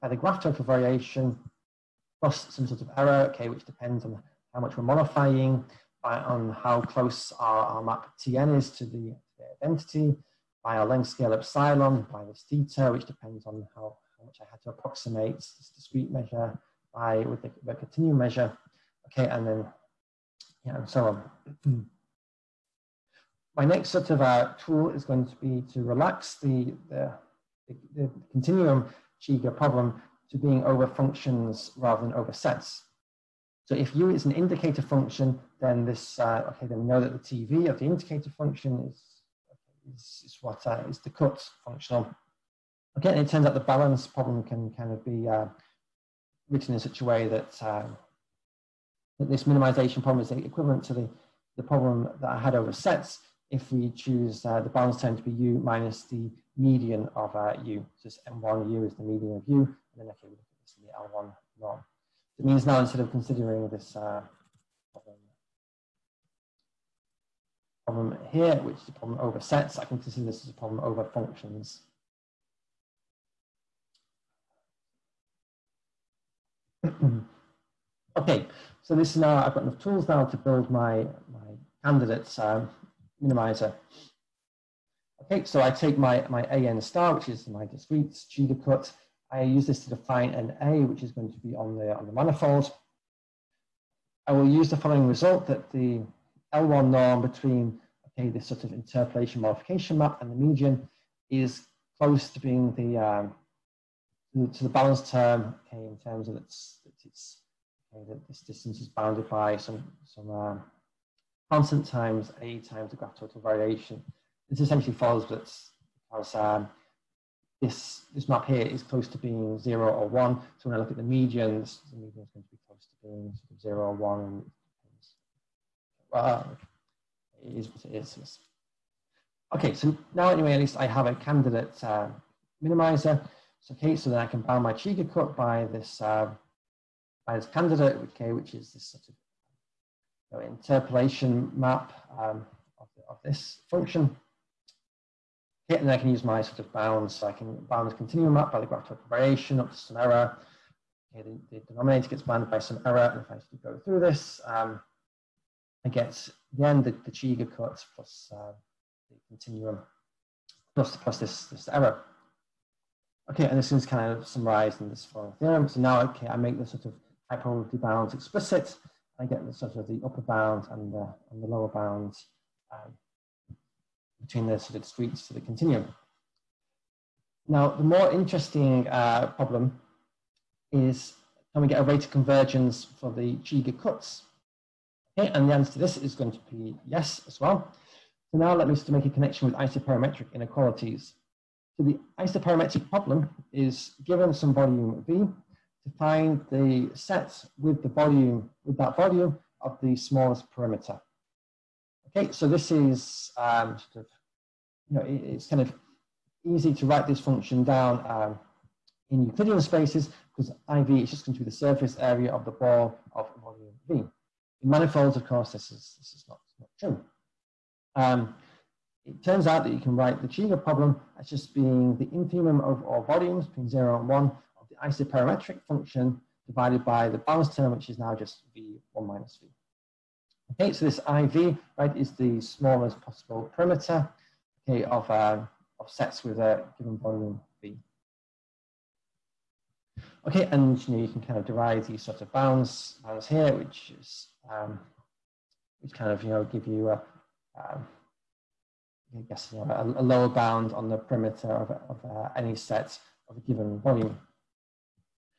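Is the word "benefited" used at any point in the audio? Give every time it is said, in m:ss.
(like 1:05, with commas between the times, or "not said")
not said.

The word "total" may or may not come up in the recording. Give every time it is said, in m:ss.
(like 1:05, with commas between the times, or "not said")
0:00, 1:53, 2:28.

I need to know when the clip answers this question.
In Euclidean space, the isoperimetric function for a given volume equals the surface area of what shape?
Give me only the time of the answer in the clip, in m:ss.
3:32.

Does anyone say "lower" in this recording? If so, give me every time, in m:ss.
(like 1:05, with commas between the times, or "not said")
2:51, 4:10.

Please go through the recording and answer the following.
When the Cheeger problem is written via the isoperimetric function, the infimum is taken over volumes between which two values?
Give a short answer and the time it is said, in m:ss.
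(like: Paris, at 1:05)
0 and 1, at 3:43.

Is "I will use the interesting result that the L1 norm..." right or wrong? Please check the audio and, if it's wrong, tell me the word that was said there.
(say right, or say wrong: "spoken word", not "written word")
wrong: "following", not "interesting".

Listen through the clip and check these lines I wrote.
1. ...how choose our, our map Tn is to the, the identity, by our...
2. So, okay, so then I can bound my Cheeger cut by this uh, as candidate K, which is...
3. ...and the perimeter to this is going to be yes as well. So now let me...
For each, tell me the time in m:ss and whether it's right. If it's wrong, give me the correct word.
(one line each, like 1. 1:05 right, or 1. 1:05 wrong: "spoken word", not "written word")
1. 0:06 wrong: "close", not "choose"
2. 2:13 right
3. 3:05 wrong: "answer", not "perimeter".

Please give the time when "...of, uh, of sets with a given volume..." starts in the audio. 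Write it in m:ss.
3:54.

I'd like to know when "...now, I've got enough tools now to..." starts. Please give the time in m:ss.
1:19.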